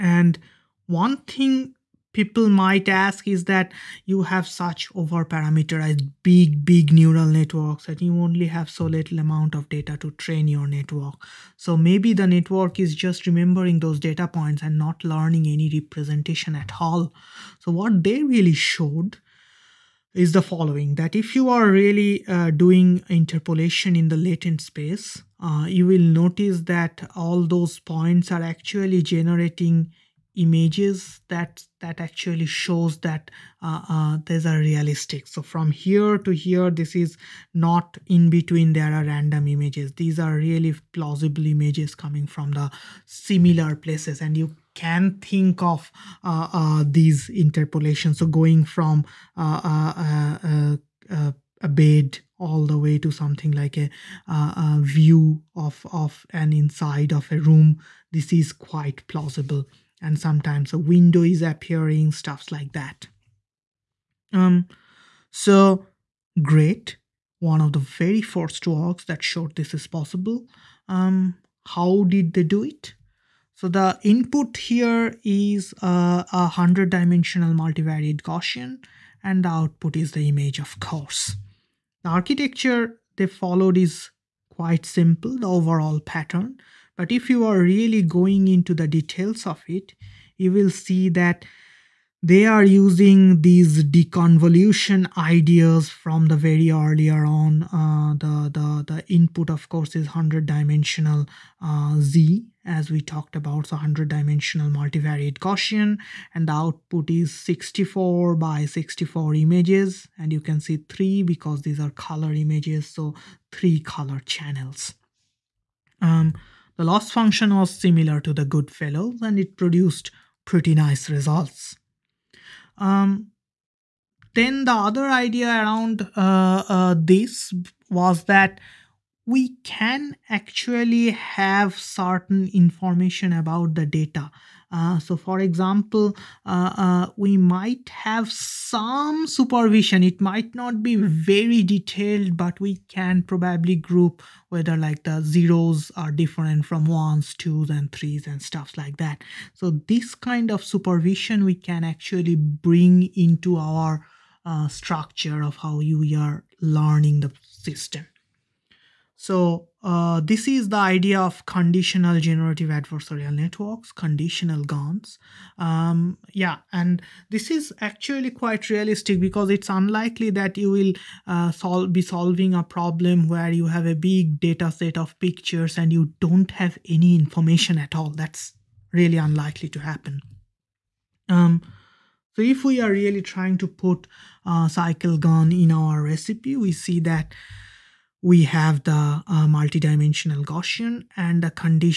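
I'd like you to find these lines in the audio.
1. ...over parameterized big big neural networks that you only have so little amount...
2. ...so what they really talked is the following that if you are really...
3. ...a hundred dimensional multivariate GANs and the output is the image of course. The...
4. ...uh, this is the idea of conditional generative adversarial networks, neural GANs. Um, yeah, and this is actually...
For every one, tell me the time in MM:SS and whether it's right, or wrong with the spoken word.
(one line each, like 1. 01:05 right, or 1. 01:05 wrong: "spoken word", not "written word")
1. 00:04 right
2. 00:17 wrong: "showed", not "talked"
3. 01:16 wrong: "Gaussian", not "GANs"
4. 02:39 wrong: "conditional", not "neural".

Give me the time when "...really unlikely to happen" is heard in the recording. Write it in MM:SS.
02:58.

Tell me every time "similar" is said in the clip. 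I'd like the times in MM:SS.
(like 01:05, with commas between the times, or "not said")
00:43, 01:57.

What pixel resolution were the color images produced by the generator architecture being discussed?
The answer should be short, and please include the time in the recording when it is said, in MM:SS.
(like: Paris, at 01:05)
64 by 64, at 01:47.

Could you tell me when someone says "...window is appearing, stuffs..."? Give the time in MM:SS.
01:00.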